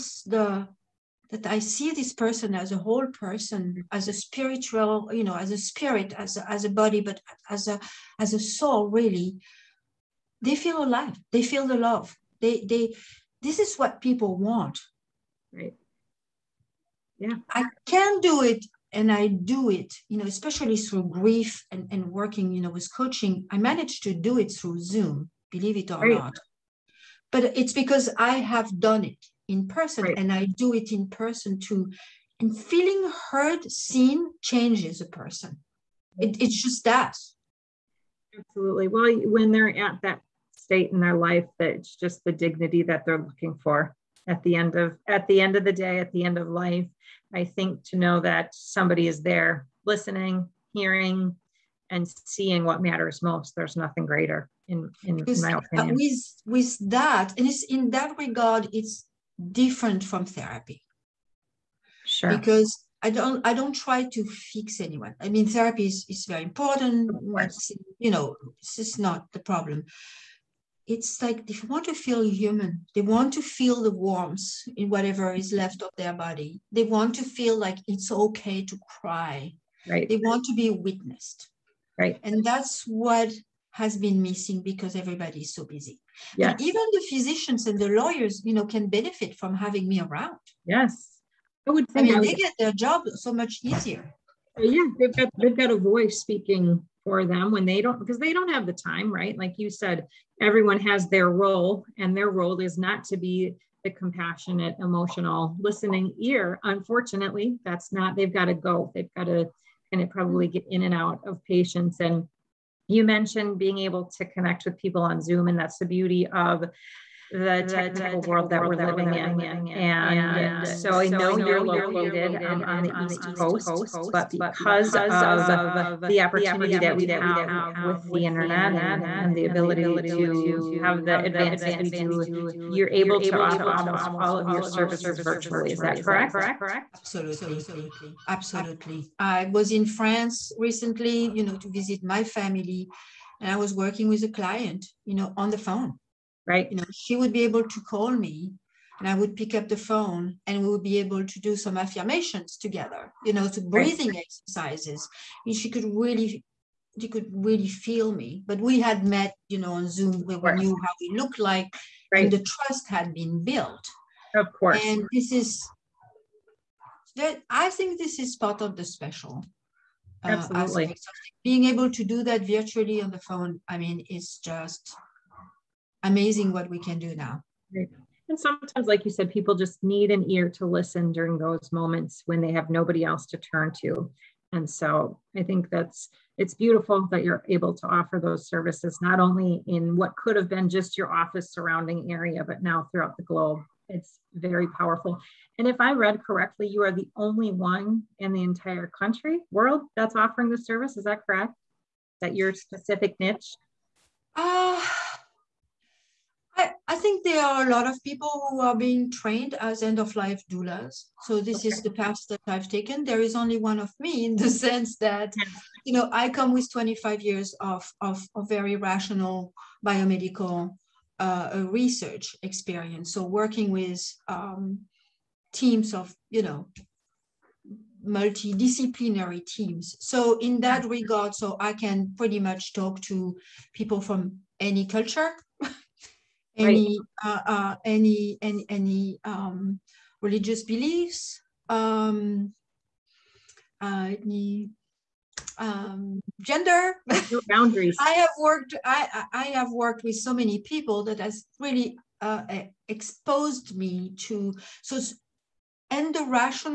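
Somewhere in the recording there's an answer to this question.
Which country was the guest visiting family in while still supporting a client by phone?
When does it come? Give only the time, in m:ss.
2:19.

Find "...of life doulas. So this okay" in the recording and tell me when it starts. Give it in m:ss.
3:29.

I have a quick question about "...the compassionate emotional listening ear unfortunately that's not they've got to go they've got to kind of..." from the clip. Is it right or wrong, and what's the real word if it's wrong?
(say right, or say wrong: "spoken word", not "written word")
right.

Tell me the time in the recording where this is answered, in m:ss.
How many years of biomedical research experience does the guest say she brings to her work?
3:36.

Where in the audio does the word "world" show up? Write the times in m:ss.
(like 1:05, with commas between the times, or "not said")
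1:58, 3:19.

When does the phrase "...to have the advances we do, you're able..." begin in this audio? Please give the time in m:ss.
2:10.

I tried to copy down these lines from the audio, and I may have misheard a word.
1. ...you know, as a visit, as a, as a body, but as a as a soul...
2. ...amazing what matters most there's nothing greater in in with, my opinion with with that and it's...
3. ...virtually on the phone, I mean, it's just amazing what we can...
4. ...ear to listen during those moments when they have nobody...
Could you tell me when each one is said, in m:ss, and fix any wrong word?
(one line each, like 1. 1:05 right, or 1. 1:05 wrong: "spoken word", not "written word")
1. 0:05 wrong: "spirit", not "visit"
2. 0:52 wrong: "seeing", not "amazing"
3. 2:52 right
4. 3:00 right.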